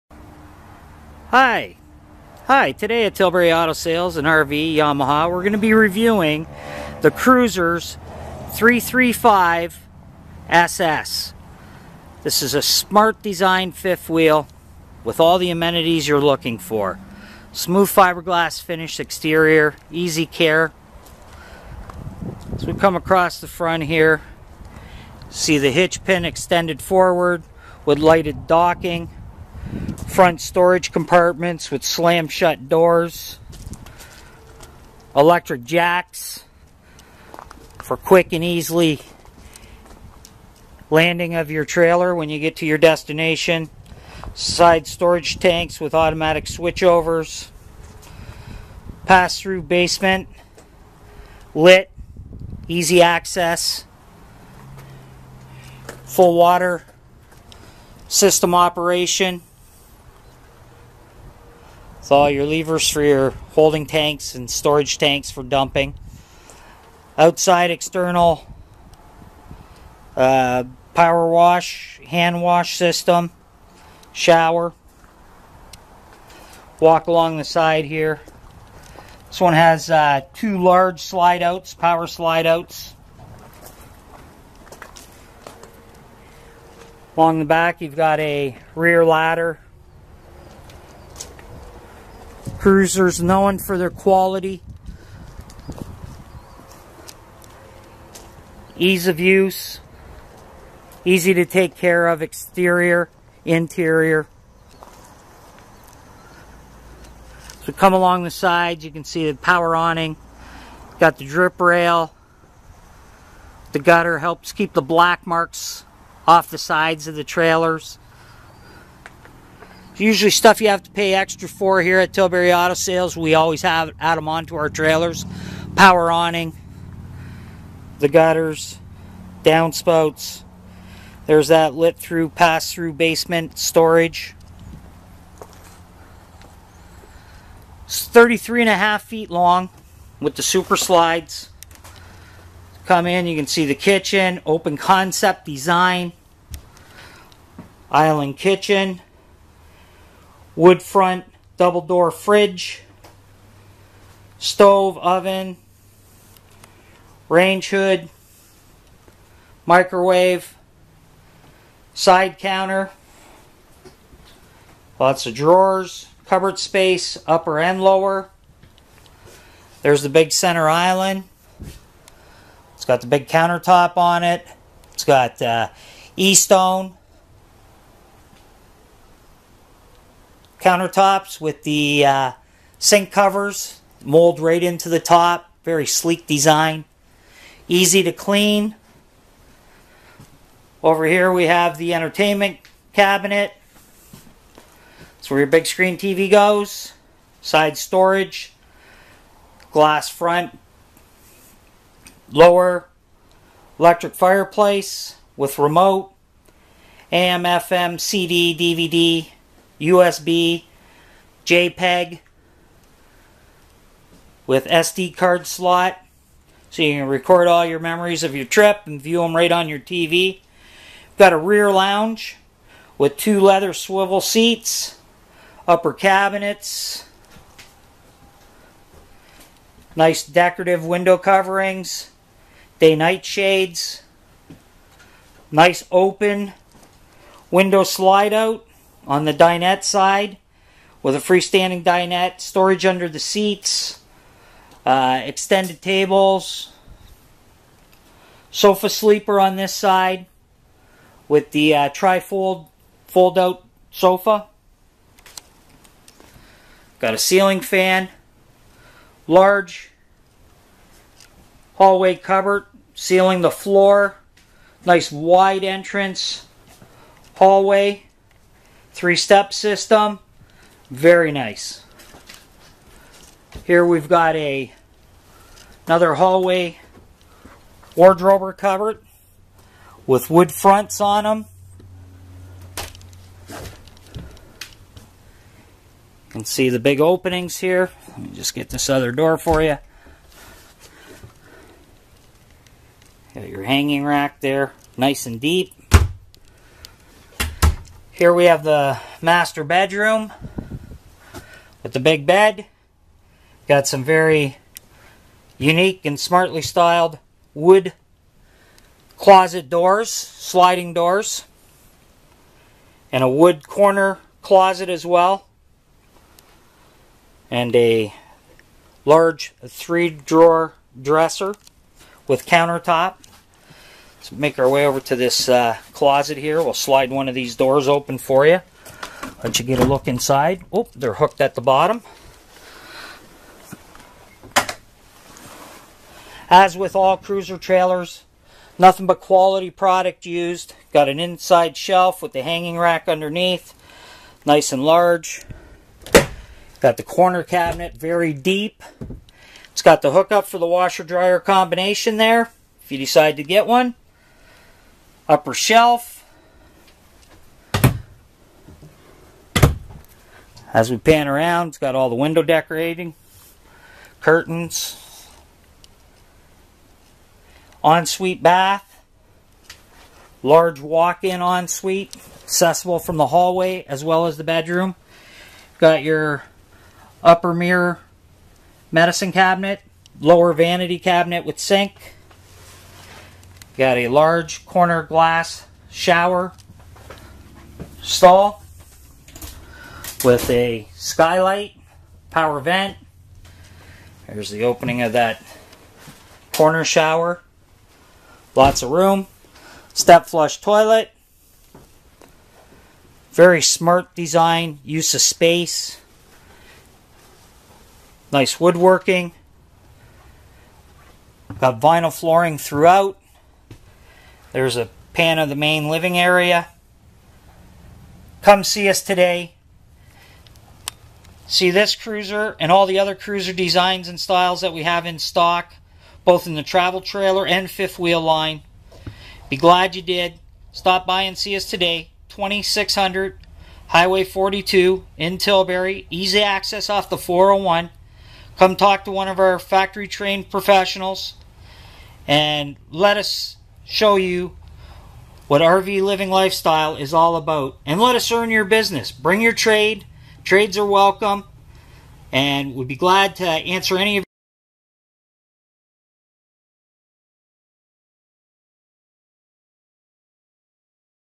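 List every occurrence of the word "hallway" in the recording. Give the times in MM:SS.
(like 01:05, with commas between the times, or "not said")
04:21, 04:27, 04:36, 06:13.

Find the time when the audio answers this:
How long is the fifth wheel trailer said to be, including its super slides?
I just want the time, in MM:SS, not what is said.
02:18.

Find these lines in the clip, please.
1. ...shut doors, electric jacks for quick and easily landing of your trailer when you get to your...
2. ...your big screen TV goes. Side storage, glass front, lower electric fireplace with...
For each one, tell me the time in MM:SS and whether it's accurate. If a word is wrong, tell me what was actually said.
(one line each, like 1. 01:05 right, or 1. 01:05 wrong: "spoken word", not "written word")
1. 00:32 right
2. 03:15 right.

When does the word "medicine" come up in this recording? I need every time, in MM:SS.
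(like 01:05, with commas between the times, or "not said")
06:18.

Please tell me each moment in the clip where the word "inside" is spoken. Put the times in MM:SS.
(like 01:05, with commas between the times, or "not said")
05:30, 05:41.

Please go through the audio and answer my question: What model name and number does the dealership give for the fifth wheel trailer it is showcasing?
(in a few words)
Cruiser's 335 SS.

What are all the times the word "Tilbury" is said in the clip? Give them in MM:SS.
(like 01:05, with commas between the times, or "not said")
00:03, 02:02, 07:15.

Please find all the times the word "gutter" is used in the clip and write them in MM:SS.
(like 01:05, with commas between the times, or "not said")
01:53, 02:08.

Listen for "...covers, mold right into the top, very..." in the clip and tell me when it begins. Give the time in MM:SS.
03:03.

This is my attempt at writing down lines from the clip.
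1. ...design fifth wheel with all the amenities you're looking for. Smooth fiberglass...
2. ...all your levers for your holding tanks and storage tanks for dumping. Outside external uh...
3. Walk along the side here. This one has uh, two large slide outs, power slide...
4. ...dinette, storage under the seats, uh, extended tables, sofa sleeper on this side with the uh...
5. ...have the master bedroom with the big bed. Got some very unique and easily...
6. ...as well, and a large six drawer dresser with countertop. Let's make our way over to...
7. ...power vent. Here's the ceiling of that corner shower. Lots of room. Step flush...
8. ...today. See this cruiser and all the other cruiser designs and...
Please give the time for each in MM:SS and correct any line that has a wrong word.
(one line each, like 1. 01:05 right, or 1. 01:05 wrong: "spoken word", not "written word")
1. 00:13 right
2. 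01:02 right
3. 01:16 right
4. 04:01 right
5. 04:58 wrong: "smartly", not "easily"
6. 05:14 wrong: "three", not "six"
7. 06:32 wrong: "opening", not "ceiling"
8. 06:59 right.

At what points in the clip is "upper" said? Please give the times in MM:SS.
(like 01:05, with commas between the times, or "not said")
02:47, 03:45, 05:55, 06:17.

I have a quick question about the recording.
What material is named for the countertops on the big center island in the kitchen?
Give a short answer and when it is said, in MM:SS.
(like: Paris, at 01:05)
e-stone, at 02:56.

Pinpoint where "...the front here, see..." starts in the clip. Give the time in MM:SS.
00:23.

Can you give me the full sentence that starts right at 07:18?
Come talk to one of our factory trained professionals and let us show you what RV living lifestyle is all about.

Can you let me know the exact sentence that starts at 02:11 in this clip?
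There's that lit through, pass through basement storage.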